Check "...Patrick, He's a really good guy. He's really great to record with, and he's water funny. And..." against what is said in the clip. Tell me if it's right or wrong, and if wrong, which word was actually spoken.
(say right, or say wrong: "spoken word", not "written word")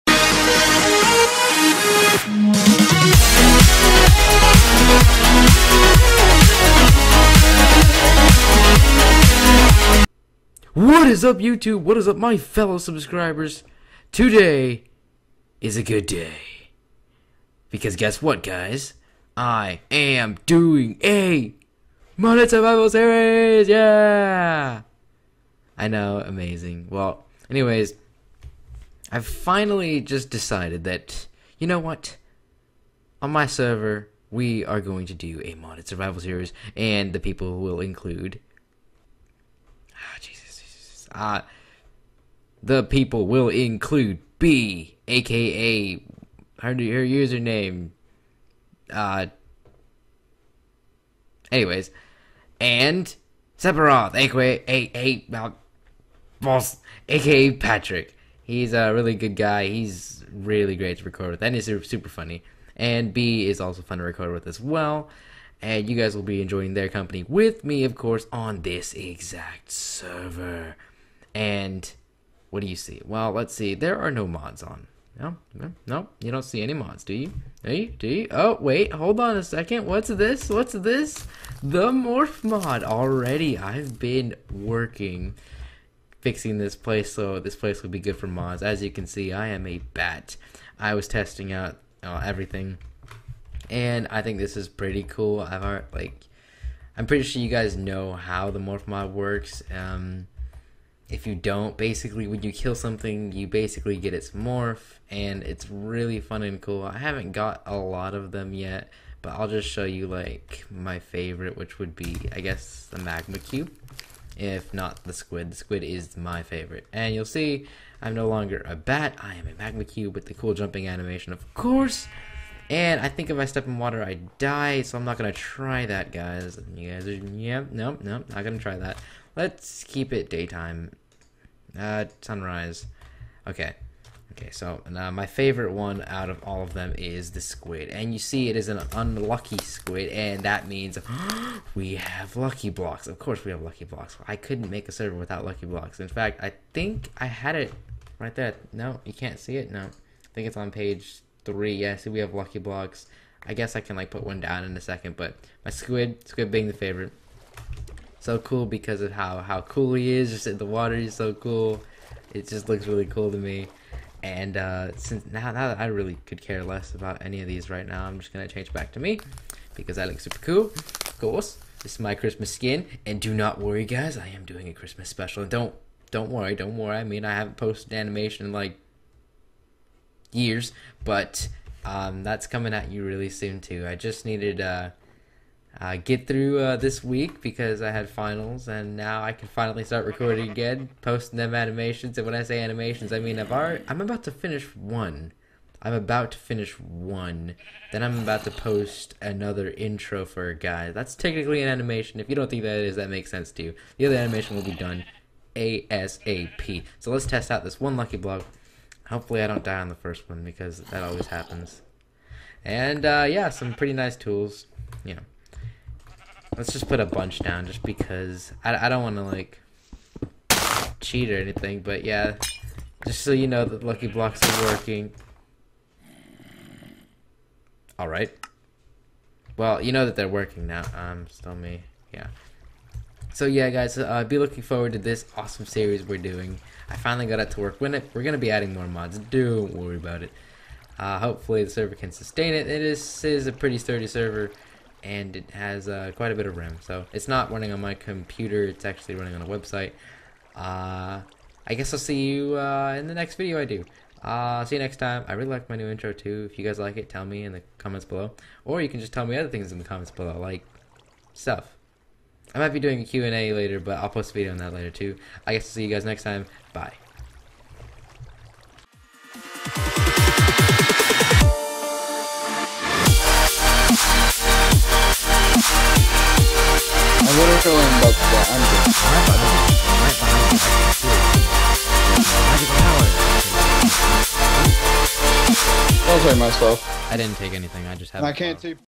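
wrong: "super", not "water".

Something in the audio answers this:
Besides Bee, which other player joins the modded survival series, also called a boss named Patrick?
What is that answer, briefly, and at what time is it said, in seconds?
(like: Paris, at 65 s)
Sephiroth, at 53 s.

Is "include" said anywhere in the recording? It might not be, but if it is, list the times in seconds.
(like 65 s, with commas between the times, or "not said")
37 s, 43 s.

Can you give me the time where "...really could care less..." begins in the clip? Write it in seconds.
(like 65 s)
165 s.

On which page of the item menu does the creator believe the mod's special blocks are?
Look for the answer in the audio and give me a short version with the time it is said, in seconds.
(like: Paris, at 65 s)
page 3, at 150 s.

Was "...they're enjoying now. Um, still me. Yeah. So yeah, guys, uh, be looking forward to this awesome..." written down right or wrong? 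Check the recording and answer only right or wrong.
wrong.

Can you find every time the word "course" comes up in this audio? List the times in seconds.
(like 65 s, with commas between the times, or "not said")
67 s, 121 s, 143 s, 171 s.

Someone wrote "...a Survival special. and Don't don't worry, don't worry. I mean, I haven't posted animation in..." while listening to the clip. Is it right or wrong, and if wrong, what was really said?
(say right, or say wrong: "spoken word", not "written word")
wrong: "Christmas", not "Survival".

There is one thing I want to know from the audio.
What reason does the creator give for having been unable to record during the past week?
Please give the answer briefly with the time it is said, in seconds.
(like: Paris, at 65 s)
finals, at 187 s.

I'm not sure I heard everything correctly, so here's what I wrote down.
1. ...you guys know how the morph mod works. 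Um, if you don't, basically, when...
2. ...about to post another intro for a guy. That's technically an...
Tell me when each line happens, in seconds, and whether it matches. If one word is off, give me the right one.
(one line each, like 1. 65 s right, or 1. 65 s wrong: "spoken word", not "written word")
1. 97 s right
2. 198 s right.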